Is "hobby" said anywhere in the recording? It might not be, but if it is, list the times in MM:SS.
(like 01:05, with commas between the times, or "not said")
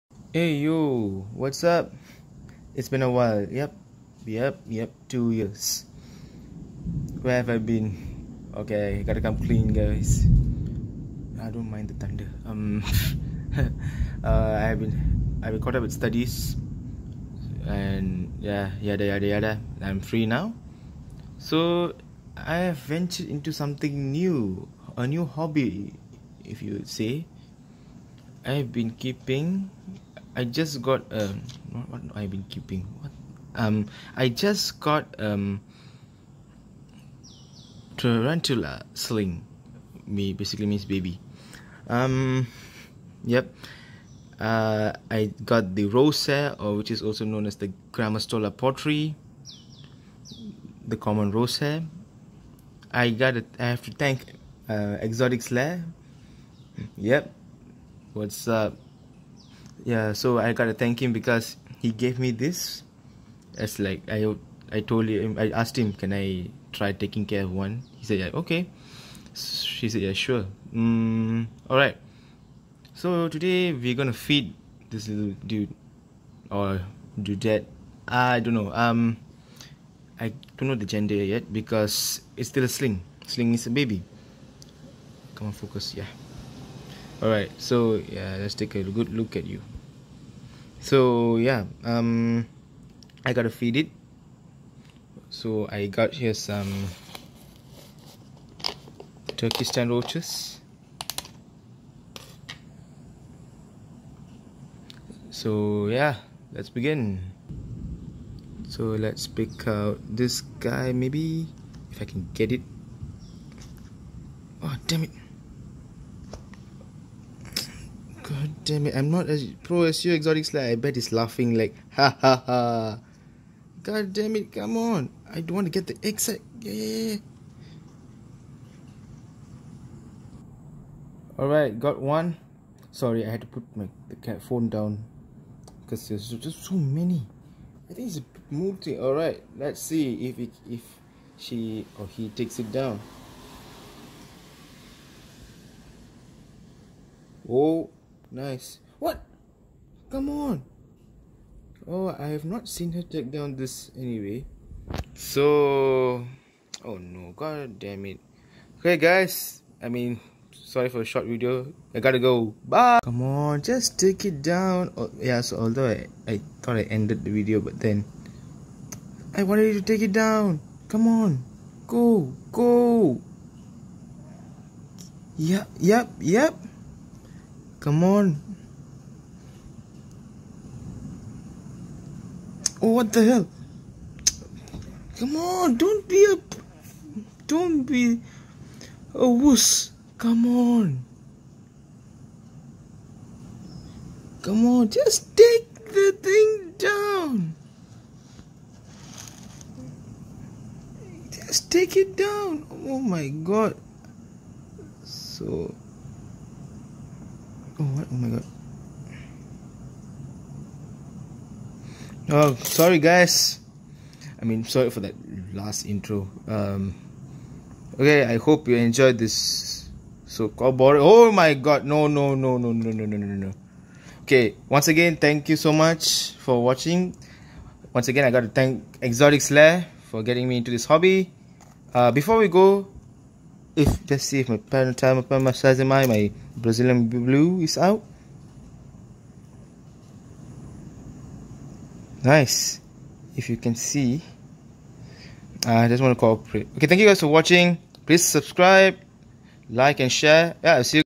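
00:25, 03:50.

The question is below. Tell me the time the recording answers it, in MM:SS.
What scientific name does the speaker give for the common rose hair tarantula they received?
00:47.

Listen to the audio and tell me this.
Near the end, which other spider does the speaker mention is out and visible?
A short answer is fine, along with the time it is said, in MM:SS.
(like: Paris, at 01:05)
Brazilian blue, at 03:56.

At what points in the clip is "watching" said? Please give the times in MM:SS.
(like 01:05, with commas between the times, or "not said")
03:46, 04:07.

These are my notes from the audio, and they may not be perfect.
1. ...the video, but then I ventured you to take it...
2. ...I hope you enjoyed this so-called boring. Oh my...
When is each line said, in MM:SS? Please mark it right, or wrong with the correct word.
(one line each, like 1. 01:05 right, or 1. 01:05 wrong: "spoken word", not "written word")
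1. 02:47 wrong: "wanted", not "ventured"
2. 03:38 right.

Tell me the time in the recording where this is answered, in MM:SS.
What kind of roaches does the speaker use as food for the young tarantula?
01:39.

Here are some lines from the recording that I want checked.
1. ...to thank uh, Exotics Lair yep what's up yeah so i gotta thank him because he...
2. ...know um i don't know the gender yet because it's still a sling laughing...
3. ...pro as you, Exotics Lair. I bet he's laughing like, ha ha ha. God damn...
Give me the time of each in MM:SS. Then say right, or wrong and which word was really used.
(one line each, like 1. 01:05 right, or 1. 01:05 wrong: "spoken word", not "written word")
1. 00:53 right
2. 01:18 wrong: "sling", not "laughing"
3. 01:59 right.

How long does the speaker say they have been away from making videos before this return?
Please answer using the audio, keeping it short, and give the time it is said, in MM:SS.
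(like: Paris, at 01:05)
2 years, at 00:05.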